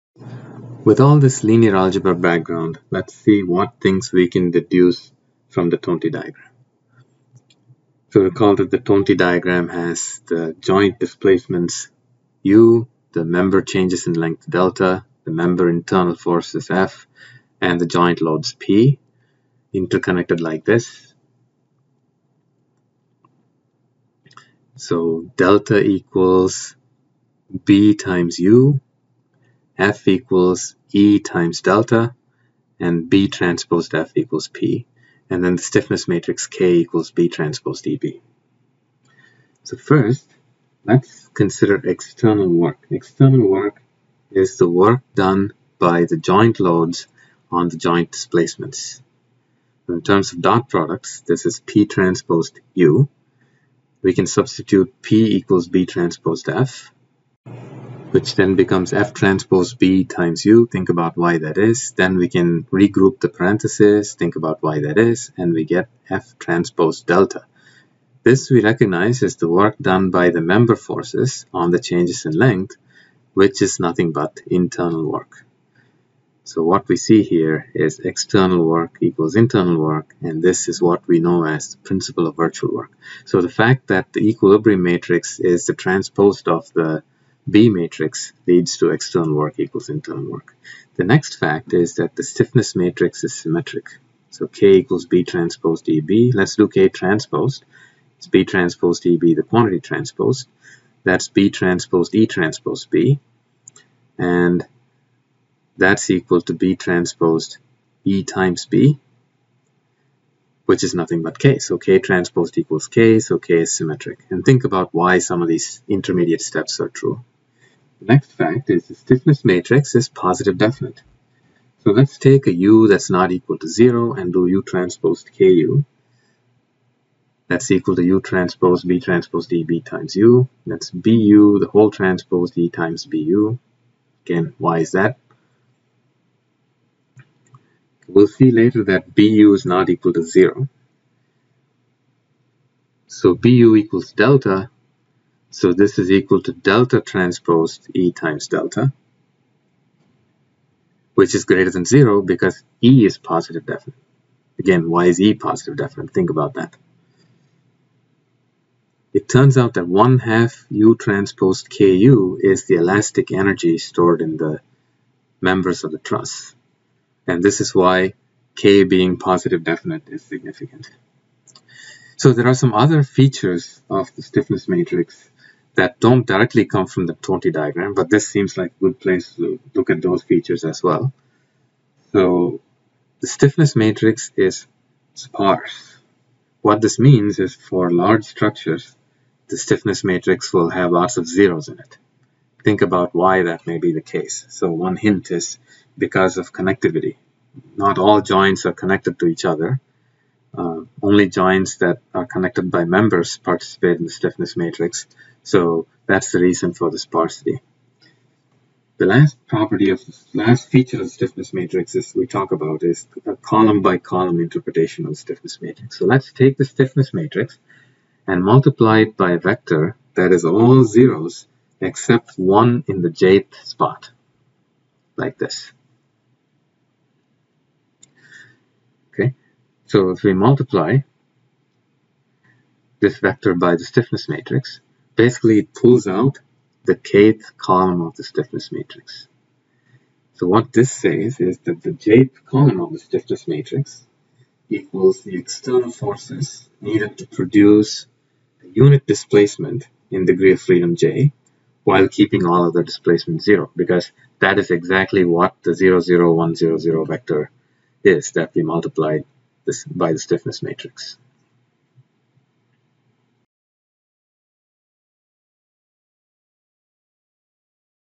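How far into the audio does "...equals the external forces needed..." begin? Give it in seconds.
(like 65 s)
244 s.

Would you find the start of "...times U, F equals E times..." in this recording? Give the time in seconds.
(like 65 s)
27 s.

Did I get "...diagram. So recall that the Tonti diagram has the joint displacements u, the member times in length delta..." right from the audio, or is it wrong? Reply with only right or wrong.
wrong.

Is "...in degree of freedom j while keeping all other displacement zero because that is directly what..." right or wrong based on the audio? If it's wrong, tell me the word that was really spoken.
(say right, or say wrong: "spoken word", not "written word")
wrong: "exactly", not "directly".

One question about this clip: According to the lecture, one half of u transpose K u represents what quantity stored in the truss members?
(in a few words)
Elastic energy.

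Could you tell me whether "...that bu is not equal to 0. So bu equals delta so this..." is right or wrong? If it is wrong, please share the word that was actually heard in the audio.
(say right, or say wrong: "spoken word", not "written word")
right.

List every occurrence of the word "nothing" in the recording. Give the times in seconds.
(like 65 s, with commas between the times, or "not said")
73 s, 110 s.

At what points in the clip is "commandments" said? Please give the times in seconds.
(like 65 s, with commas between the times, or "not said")
not said.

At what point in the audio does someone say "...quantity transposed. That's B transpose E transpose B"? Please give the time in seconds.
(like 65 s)
99 s.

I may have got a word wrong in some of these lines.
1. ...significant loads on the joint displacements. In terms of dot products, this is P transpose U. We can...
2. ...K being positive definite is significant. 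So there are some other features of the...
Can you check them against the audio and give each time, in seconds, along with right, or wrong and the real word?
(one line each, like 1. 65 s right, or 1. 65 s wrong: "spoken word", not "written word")
1. 46 s wrong: "joint", not "significant"
2. 168 s right.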